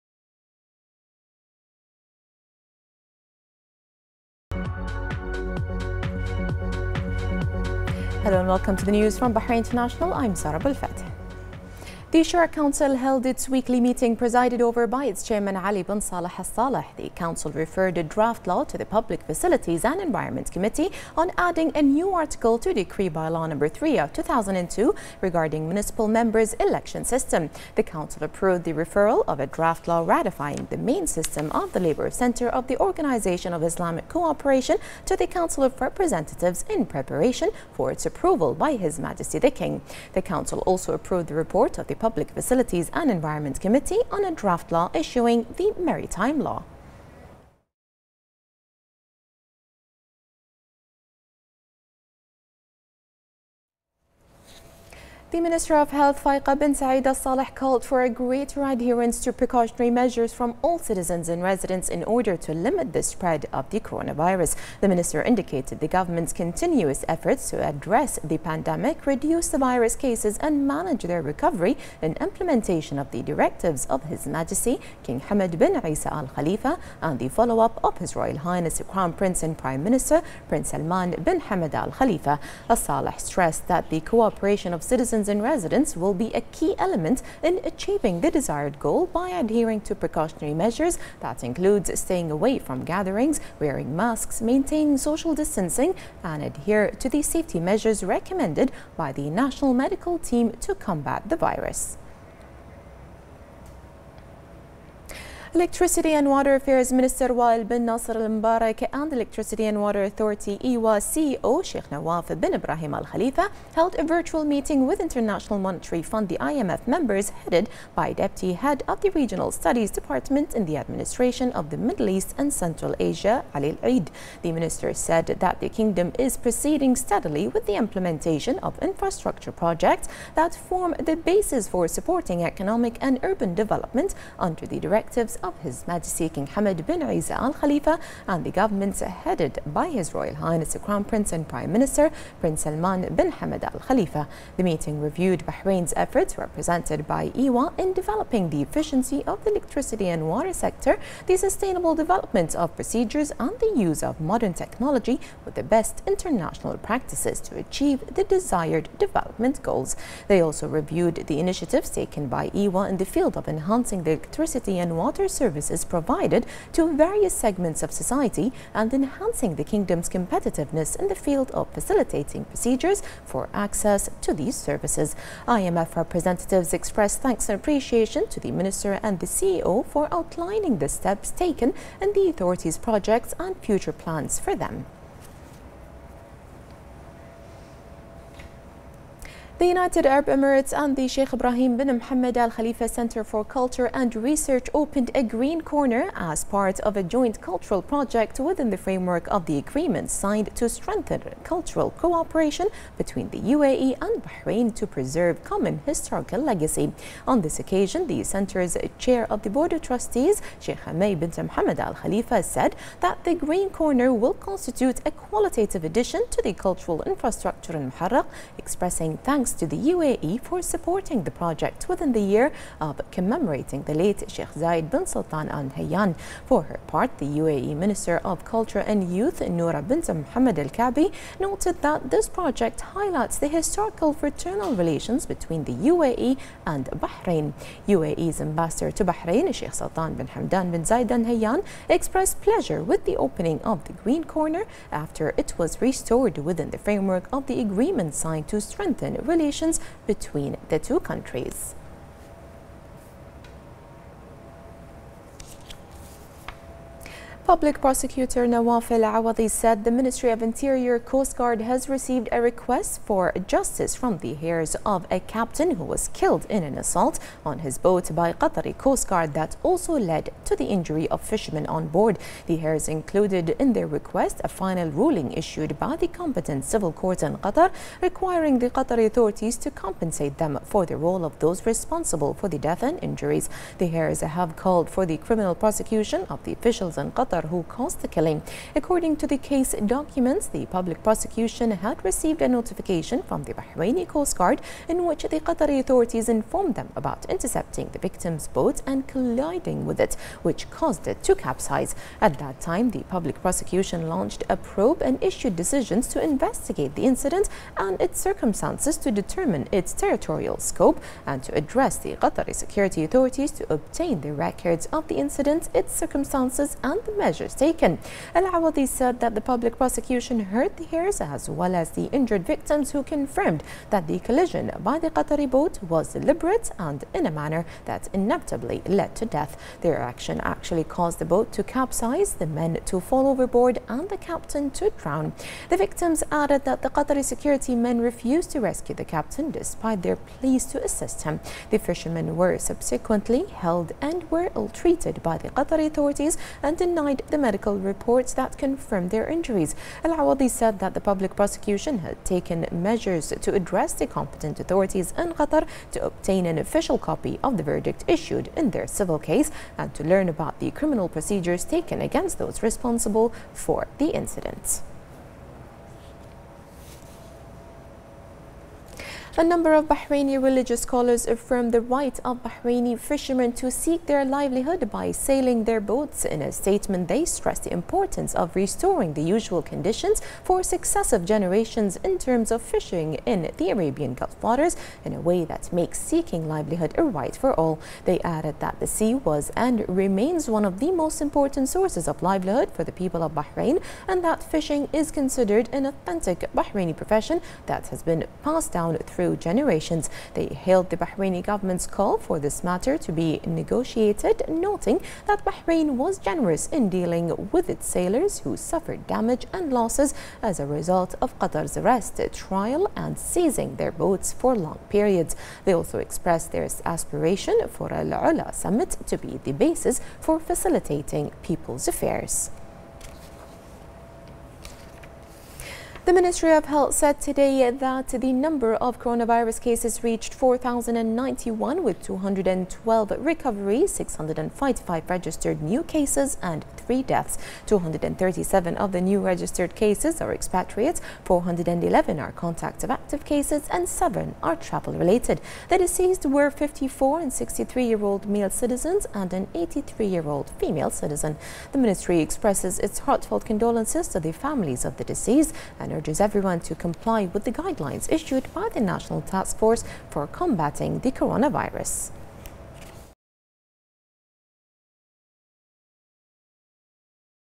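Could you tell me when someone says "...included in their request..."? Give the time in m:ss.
4:32.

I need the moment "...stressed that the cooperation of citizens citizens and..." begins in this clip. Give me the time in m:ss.
1:23.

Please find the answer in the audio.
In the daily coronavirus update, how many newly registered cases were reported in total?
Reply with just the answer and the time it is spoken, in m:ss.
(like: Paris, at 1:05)
655, at 7:13.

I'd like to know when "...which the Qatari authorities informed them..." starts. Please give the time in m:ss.
4:55.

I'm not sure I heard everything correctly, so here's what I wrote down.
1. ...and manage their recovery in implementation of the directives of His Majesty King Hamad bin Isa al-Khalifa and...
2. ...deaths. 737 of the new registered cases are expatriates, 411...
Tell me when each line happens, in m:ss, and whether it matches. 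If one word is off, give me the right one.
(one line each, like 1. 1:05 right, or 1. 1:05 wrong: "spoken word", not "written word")
1. 1:10 right
2. 7:17 wrong: "237", not "737".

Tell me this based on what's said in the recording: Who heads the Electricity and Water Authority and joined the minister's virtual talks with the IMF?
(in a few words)
Sheikh Nawaf bin Ibrahim Al Khalifa.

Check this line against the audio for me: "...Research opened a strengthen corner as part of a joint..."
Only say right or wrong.
wrong.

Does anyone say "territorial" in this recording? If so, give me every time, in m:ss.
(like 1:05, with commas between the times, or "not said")
5:09.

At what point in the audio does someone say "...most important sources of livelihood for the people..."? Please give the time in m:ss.
6:30.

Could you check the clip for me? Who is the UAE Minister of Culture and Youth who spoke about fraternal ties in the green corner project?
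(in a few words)
Noura bint Mohammed Al Kaabi.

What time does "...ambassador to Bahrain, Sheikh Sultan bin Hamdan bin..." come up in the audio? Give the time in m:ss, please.
3:58.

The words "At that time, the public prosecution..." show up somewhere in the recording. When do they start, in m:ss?
5:02.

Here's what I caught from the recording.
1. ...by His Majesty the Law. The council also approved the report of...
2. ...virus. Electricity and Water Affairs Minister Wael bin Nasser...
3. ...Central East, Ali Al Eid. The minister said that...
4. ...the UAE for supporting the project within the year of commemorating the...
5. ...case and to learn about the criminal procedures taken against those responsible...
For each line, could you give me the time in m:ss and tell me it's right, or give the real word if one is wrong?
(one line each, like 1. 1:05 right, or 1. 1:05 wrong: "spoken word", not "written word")
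1. 0:38 wrong: "King", not "Law"
2. 1:41 right
3. 2:02 wrong: "Asia", not "East"
4. 3:39 right
5. 5:59 right.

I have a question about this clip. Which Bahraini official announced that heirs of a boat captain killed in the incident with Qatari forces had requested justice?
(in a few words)
Nawaf El Awadi.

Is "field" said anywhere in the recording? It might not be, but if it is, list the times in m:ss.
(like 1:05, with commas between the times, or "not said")
2:43, 2:51.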